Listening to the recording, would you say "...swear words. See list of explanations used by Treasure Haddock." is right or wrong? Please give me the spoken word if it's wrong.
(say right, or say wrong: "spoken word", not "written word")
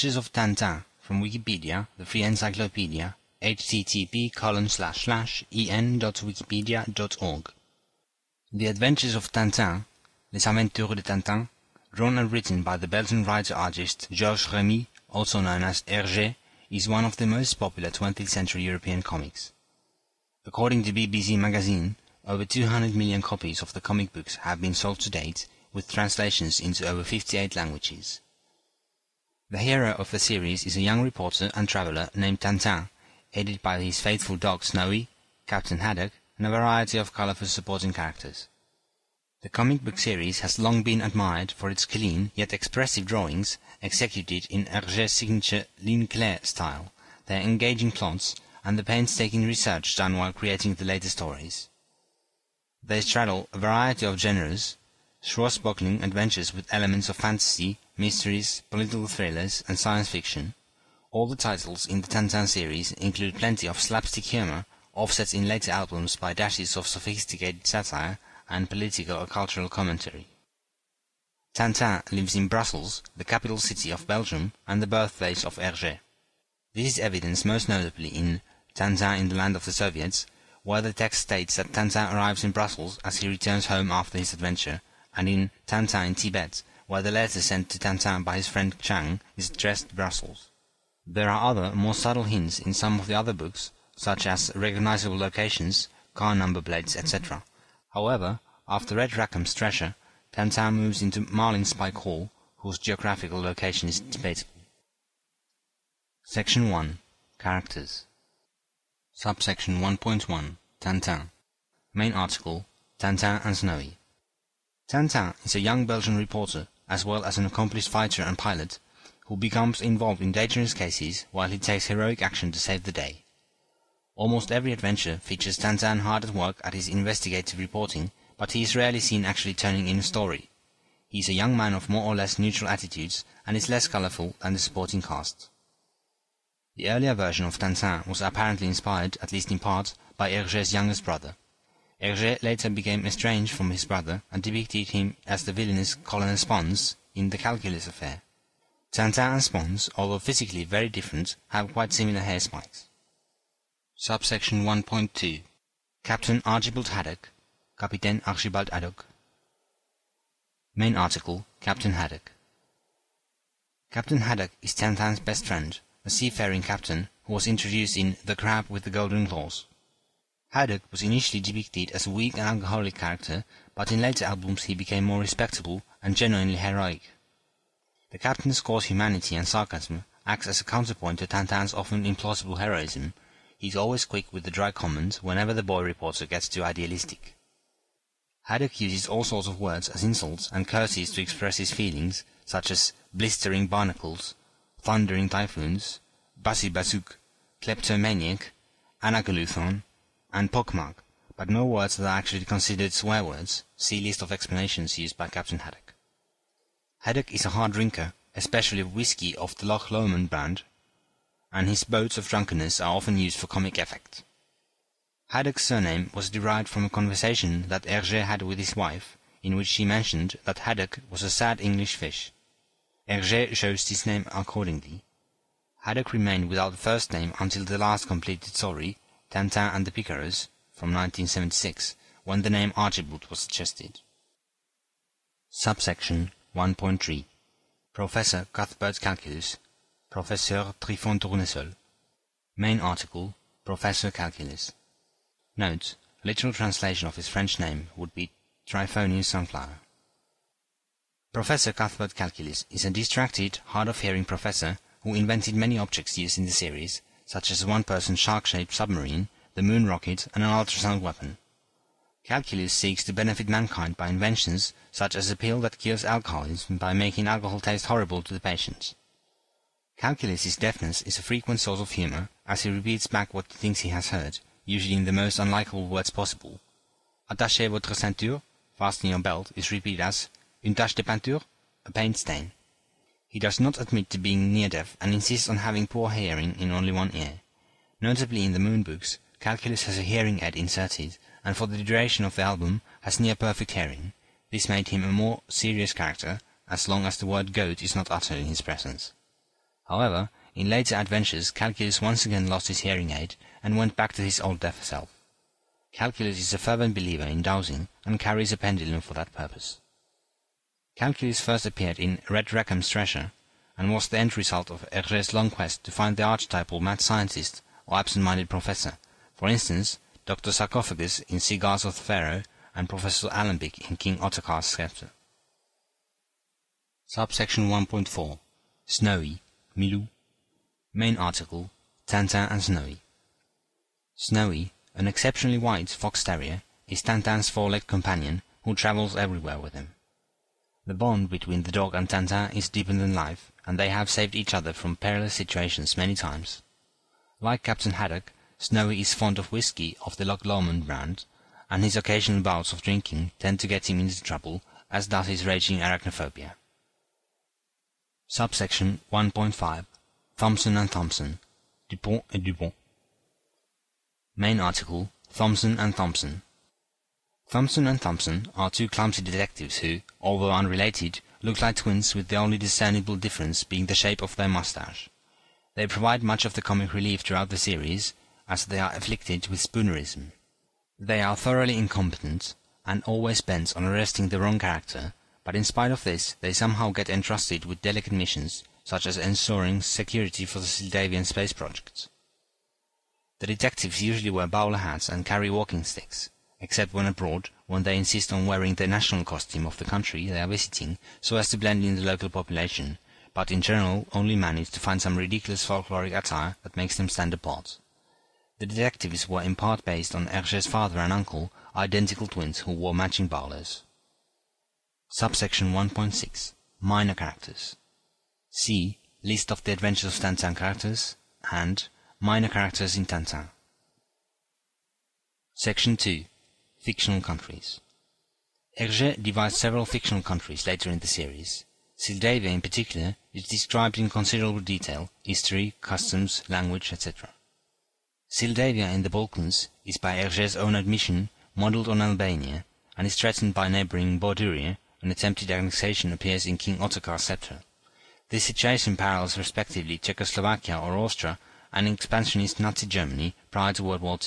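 wrong: "Captain", not "Treasure".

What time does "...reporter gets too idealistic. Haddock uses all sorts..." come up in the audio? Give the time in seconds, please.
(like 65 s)
185 s.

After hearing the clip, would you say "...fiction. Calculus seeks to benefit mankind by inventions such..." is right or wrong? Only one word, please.
wrong.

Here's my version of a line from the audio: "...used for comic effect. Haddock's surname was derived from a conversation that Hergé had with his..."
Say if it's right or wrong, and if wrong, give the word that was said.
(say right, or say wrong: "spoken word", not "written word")
right.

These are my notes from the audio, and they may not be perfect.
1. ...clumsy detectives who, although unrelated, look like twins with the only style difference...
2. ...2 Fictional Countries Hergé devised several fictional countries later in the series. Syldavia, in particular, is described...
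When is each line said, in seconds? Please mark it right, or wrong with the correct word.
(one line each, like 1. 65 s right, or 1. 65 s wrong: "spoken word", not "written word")
1. 368 s wrong: "discernible", not "style"
2. 425 s right.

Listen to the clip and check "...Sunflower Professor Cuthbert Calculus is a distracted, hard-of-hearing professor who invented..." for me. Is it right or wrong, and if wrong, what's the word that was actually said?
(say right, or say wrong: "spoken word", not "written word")
right.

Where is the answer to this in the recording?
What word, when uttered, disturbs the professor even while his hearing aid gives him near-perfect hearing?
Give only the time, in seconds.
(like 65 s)
297 s.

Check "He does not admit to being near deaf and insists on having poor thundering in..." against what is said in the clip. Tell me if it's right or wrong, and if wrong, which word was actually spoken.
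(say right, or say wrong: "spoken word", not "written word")
wrong: "hearing", not "thundering".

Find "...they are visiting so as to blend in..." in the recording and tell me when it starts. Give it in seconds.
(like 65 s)
400 s.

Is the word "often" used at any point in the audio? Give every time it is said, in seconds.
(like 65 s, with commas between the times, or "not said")
181 s, 212 s.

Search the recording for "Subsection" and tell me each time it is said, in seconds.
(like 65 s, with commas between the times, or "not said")
109 s, 153 s, 235 s, 327 s, 358 s, 415 s.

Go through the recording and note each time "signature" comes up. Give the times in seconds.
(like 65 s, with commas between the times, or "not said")
45 s.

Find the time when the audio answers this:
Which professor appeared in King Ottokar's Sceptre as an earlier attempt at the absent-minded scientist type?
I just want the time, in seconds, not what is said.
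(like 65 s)
322 s.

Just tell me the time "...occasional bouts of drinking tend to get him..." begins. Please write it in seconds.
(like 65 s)
351 s.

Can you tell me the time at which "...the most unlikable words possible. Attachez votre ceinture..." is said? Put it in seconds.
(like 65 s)
275 s.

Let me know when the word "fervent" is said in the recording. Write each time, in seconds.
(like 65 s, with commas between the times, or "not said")
306 s.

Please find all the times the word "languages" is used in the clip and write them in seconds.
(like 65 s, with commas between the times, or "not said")
27 s, 436 s.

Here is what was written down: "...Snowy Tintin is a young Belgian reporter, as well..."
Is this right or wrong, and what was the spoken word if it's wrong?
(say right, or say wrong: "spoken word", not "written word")
right.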